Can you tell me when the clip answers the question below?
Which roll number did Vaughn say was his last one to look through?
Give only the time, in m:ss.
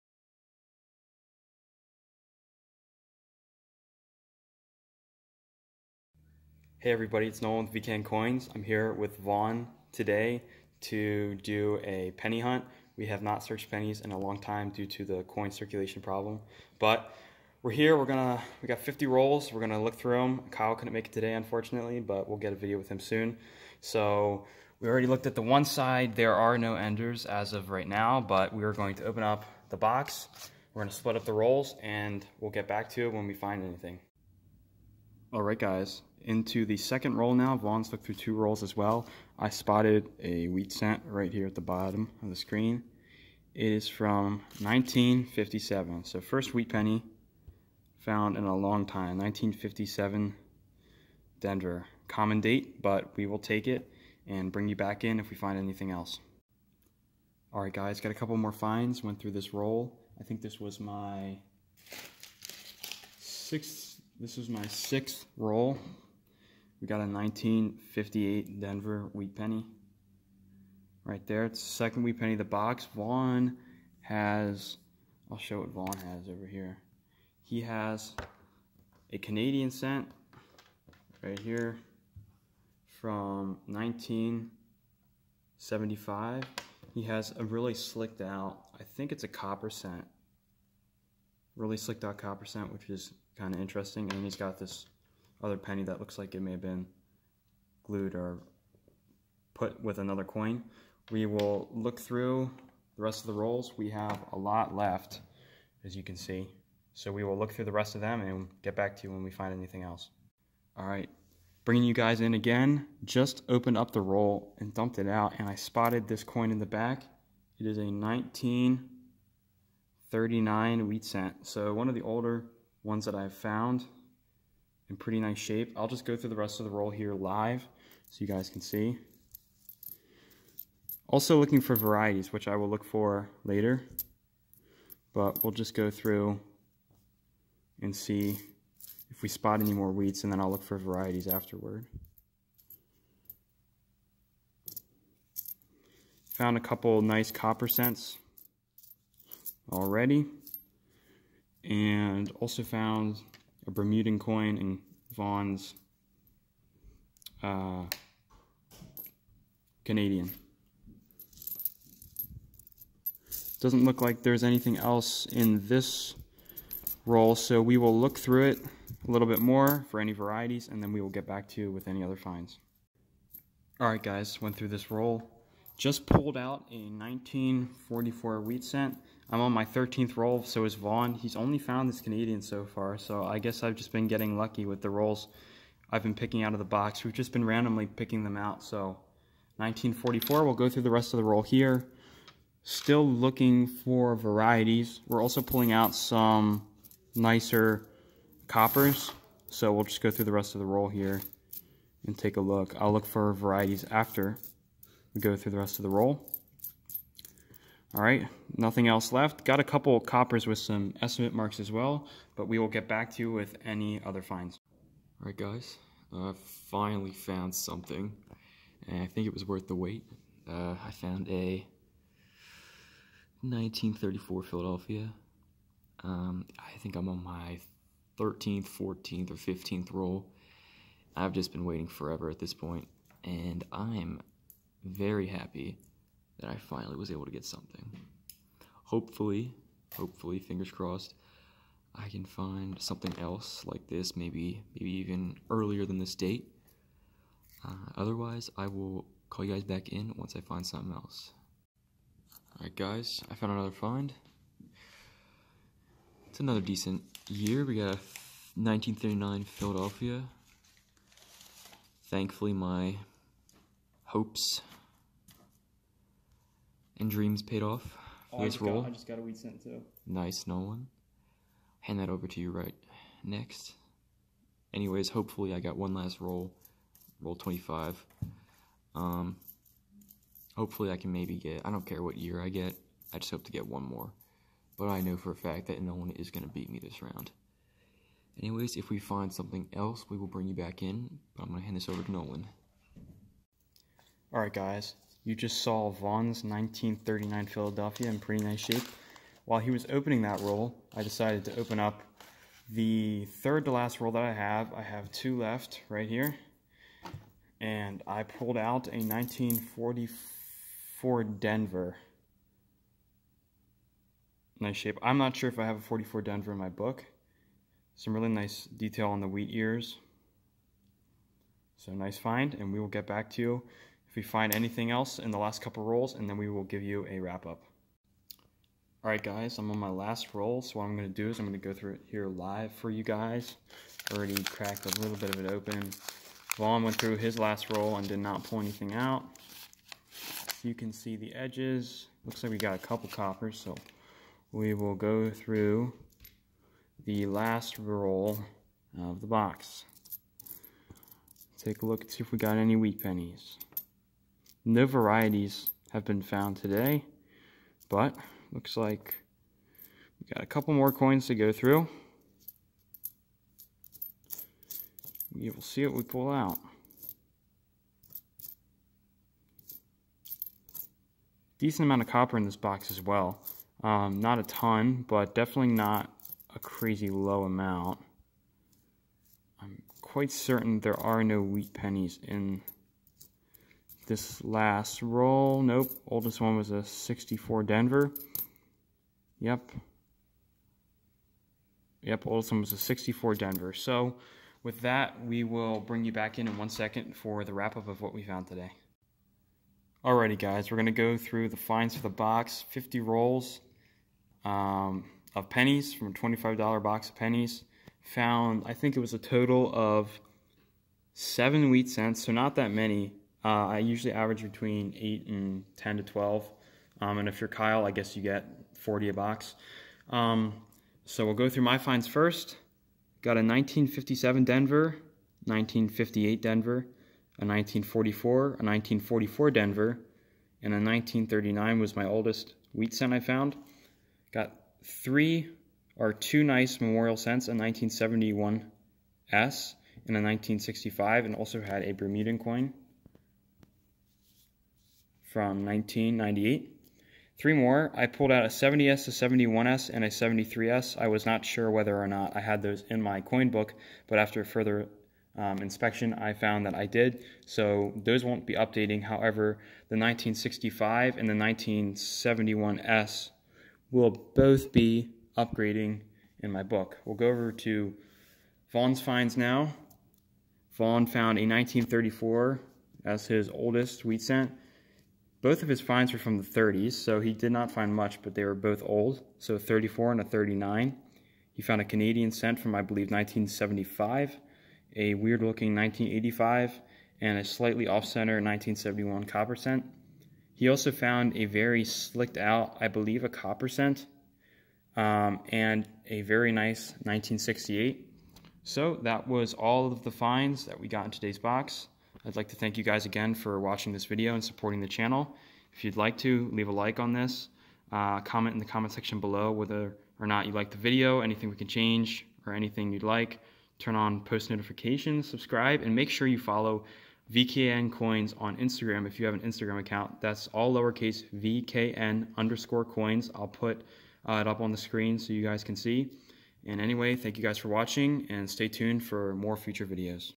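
4:37.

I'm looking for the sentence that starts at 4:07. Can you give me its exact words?
Uh, otherwise, I will call you guys back in once I find something else.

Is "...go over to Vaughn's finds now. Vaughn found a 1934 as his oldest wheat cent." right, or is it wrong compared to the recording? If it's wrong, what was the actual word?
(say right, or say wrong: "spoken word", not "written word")
right.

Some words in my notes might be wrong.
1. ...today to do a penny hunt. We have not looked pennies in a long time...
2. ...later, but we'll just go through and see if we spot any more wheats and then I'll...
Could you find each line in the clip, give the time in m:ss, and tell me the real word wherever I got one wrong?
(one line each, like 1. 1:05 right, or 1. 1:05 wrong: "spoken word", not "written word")
1. 0:09 wrong: "searched", not "looked"
2. 2:13 right.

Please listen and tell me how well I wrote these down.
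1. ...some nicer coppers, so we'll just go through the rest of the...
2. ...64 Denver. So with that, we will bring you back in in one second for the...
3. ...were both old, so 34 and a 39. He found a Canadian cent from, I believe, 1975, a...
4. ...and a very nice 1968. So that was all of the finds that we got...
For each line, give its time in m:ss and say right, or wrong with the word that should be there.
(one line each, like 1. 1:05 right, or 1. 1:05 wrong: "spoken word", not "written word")
1. 3:15 right
2. 6:32 right
3. 7:58 right
4. 8:15 right.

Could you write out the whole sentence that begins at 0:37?
Vaughn's looked through two rolls as well.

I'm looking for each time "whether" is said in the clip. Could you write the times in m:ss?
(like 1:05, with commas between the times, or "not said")
7:31, 8:29.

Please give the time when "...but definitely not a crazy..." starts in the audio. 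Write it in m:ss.
6:15.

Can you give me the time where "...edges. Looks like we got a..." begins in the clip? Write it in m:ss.
5:41.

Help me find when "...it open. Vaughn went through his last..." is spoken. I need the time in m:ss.
5:35.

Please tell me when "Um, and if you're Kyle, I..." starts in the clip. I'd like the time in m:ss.
6:57.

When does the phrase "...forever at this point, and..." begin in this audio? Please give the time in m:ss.
3:51.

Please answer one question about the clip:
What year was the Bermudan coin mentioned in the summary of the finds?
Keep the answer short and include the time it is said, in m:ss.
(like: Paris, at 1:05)
1998, at 7:25.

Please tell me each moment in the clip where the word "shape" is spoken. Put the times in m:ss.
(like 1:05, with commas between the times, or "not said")
2:05, 4:58, 5:14.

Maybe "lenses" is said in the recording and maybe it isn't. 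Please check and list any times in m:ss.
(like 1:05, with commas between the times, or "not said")
not said.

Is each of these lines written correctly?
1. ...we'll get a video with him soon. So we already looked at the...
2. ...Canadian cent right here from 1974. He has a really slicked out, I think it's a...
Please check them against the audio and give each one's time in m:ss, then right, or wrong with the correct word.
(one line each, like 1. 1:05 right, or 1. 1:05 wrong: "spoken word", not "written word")
1. 0:22 right
2. 1:19 wrong: "1975", not "1974".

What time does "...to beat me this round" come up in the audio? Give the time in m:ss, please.
4:46.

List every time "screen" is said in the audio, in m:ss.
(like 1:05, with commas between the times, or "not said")
0:42, 8:44.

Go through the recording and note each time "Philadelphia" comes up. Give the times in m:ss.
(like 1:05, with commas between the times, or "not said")
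3:44, 4:19, 4:57.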